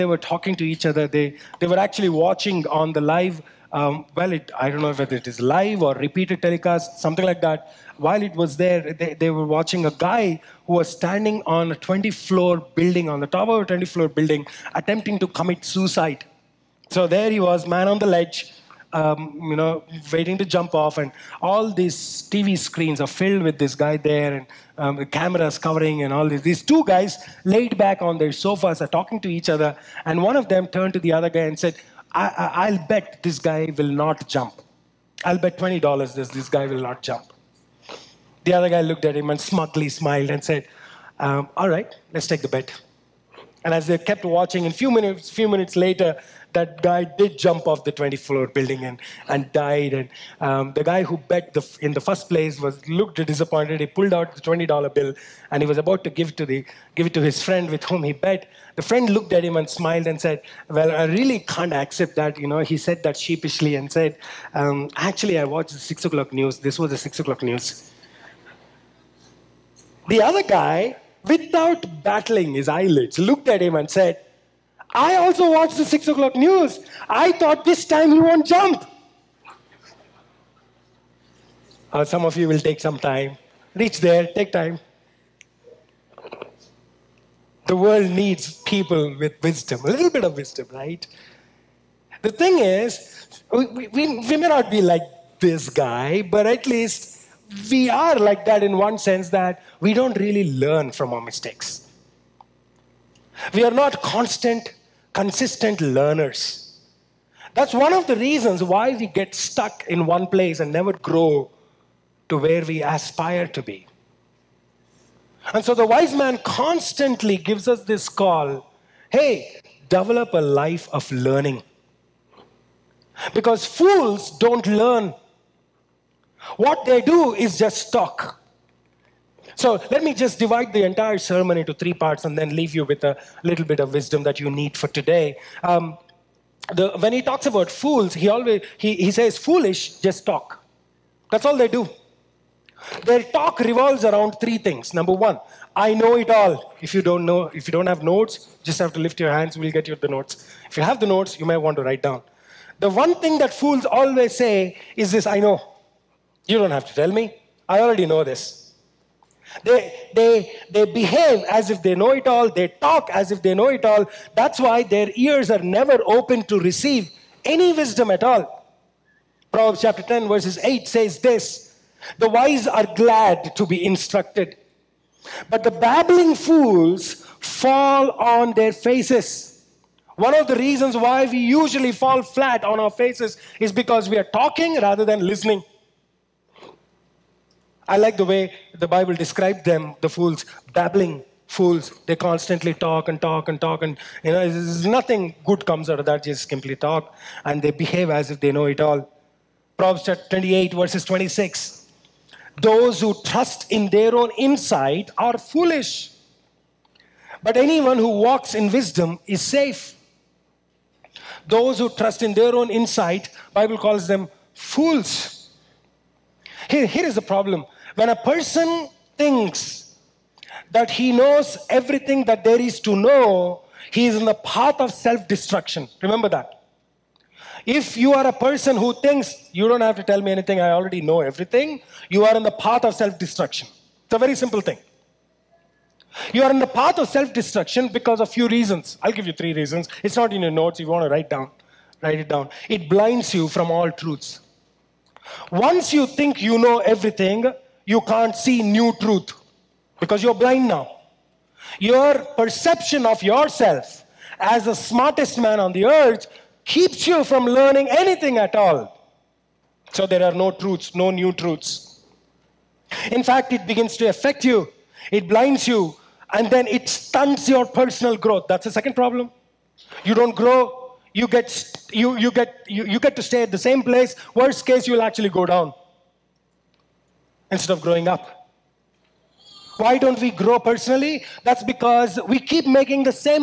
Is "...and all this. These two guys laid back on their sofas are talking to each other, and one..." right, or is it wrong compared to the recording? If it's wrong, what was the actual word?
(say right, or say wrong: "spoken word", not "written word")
right.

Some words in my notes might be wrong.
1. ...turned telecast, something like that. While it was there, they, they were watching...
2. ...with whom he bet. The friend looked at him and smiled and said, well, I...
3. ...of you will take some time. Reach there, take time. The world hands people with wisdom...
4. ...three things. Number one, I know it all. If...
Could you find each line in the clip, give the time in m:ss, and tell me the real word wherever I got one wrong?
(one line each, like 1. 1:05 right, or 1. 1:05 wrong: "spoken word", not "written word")
1. 0:05 wrong: "repeated", not "turned"
2. 0:57 right
3. 1:22 wrong: "needs", not "hands"
4. 2:24 right.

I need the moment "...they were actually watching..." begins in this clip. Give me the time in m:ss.
0:01.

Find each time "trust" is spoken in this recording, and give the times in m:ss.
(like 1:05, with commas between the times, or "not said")
3:23, 3:31.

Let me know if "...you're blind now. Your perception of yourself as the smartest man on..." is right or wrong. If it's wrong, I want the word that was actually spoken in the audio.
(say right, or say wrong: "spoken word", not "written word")
right.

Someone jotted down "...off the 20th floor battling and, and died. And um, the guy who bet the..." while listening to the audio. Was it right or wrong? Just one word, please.
wrong.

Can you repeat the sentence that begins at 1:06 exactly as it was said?
This was the 6 o'clock news.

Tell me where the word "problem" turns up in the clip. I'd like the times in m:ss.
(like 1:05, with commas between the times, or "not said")
3:37, 4:28.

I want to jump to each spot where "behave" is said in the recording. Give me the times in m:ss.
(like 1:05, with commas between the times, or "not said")
2:40, 3:17.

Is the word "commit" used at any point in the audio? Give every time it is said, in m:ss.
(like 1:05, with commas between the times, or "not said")
0:15.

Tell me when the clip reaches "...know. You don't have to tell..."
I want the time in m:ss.
2:35.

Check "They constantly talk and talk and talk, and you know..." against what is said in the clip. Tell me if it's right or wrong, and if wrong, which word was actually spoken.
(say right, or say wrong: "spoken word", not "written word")
right.